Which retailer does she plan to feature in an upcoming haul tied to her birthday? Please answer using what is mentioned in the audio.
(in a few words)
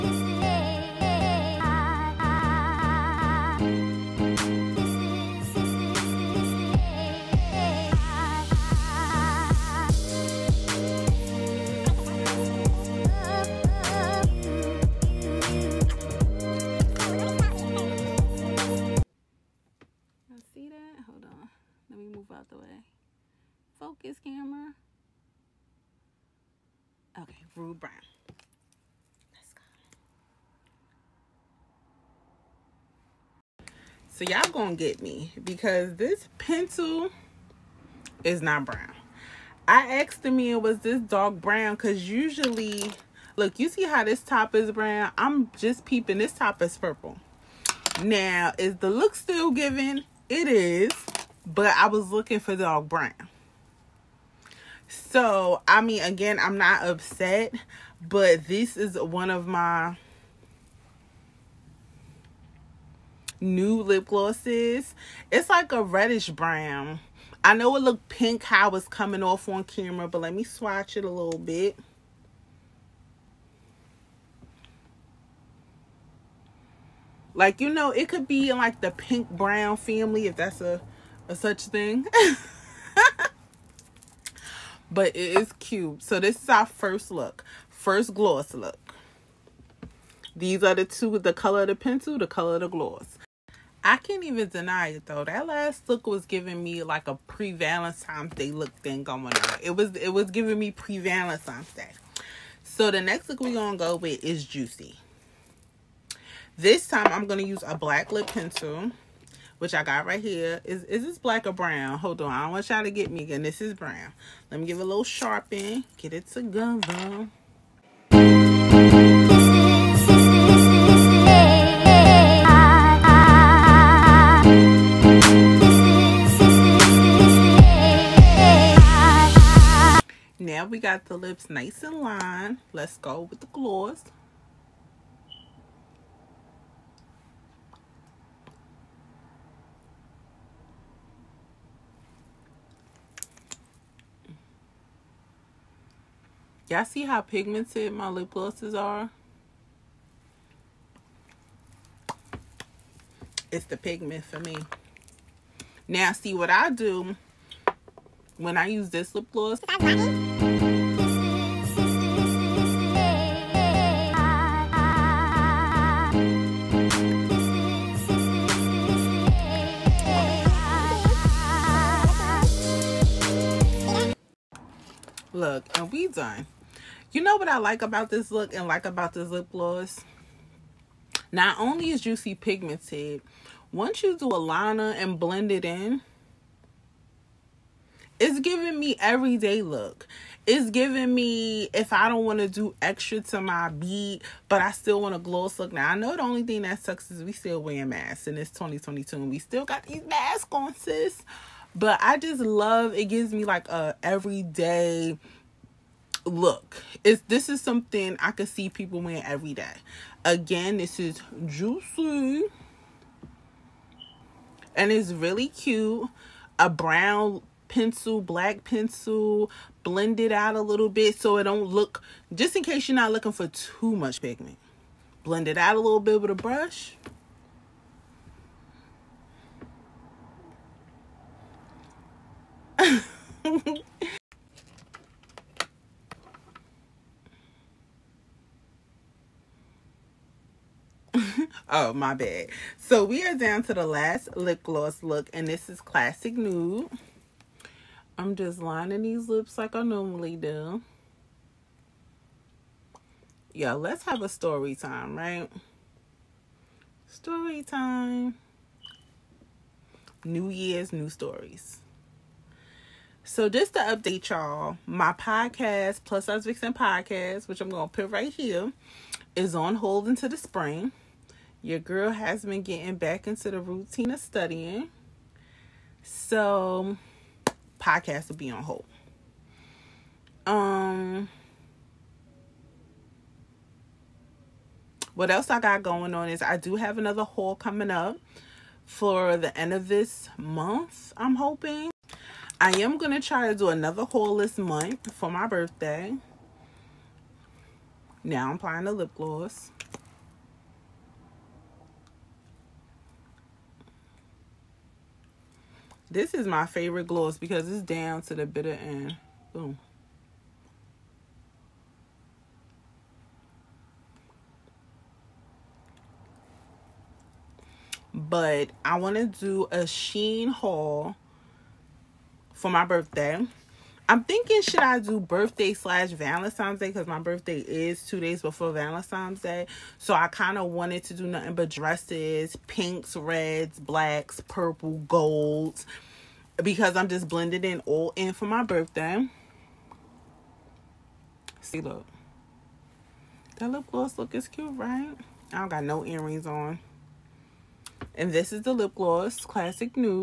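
Shein.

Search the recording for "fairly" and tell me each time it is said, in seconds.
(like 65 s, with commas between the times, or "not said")
not said.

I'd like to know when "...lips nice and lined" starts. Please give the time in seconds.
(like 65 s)
131 s.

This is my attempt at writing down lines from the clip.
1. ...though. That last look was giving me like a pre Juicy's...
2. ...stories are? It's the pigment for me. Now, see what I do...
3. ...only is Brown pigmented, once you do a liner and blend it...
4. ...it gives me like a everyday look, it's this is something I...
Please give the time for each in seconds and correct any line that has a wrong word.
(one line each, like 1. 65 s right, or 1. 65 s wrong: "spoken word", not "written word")
1. 95 s wrong: "Valentine", not "Juicy"
2. 148 s wrong: "glosses", not "stories"
3. 181 s wrong: "Juicy", not "Brown"
4. 202 s right.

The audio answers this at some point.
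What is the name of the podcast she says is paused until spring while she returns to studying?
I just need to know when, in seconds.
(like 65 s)
266 s.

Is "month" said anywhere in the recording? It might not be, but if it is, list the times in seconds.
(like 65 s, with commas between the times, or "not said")
290 s, 294 s.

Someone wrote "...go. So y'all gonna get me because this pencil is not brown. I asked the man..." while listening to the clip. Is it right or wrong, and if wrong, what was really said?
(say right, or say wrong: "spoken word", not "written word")
right.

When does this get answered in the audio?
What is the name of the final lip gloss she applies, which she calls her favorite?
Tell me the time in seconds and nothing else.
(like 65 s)
245 s.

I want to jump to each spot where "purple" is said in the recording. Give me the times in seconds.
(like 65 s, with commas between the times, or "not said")
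46 s, 334 s.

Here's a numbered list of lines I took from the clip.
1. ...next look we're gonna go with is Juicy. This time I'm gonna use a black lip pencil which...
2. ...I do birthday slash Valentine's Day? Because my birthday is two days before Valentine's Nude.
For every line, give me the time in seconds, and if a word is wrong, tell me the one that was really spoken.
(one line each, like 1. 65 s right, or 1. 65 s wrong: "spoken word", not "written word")
1. 102 s right
2. 324 s wrong: "Day", not "Nude".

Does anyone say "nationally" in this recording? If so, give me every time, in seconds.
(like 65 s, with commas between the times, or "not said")
not said.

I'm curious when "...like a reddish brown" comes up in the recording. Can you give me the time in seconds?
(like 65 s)
65 s.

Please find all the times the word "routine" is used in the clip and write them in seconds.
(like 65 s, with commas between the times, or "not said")
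273 s.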